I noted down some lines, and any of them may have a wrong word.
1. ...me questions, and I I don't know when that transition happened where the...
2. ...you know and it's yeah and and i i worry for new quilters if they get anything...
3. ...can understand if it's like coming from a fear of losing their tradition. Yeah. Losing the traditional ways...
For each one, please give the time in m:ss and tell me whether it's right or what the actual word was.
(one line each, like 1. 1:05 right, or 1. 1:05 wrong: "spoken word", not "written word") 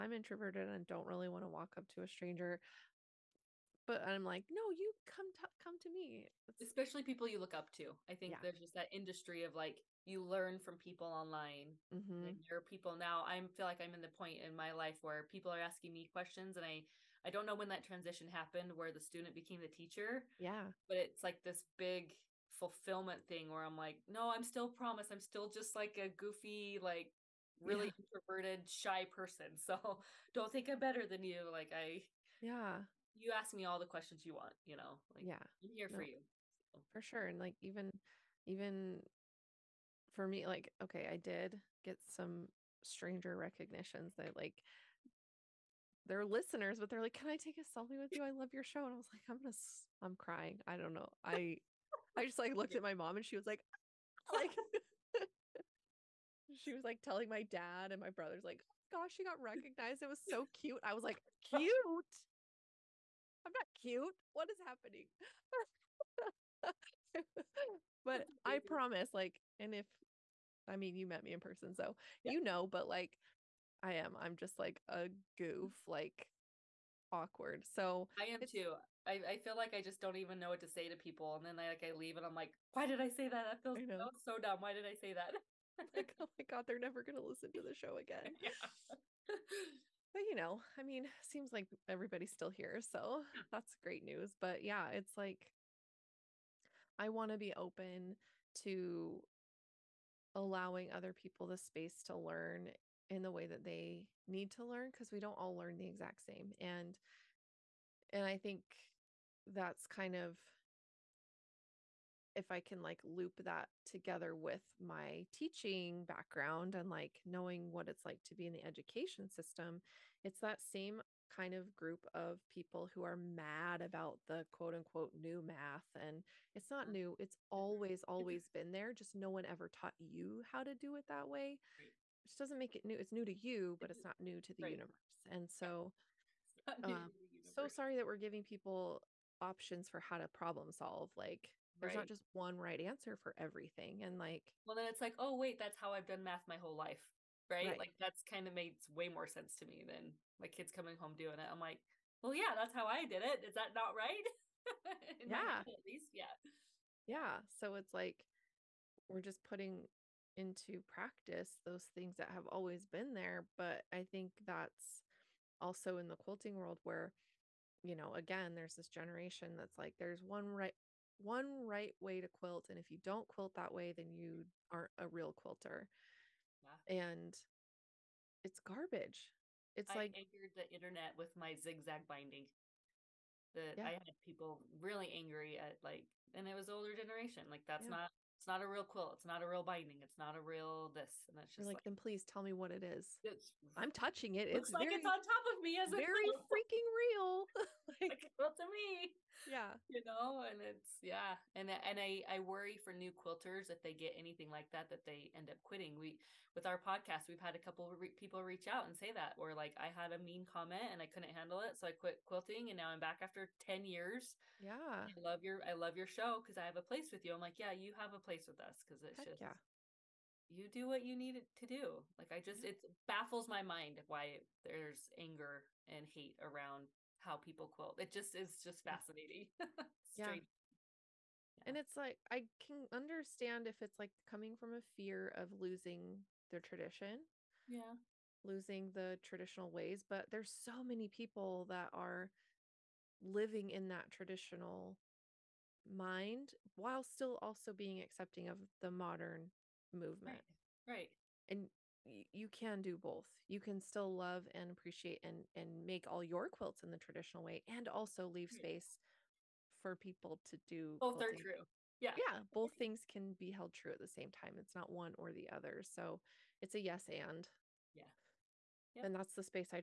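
1. 0:15 right
2. 3:19 right
3. 3:52 right.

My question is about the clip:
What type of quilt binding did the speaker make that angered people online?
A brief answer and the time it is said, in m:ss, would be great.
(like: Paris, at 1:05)
Zigzag binding, at 3:01.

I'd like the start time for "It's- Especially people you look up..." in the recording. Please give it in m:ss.
0:06.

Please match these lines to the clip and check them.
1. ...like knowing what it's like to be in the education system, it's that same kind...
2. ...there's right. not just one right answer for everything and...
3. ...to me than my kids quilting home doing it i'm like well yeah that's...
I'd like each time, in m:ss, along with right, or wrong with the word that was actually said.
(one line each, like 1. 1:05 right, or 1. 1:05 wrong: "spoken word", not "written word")
1. 1:56 right
2. 2:21 right
3. 2:29 wrong: "coming", not "quilting".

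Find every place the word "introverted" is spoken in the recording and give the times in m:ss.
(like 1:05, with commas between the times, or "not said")
0:00, 0:27.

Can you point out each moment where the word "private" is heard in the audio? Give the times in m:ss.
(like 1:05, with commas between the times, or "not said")
not said.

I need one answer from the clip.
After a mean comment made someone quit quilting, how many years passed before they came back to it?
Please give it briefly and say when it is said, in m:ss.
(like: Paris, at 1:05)
10 years, at 3:33.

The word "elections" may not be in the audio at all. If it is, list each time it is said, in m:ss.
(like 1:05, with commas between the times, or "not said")
not said.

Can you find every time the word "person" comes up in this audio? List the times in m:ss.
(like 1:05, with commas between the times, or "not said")
0:29, 1:11.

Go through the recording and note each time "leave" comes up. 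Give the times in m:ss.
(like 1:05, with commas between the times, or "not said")
1:21, 4:18.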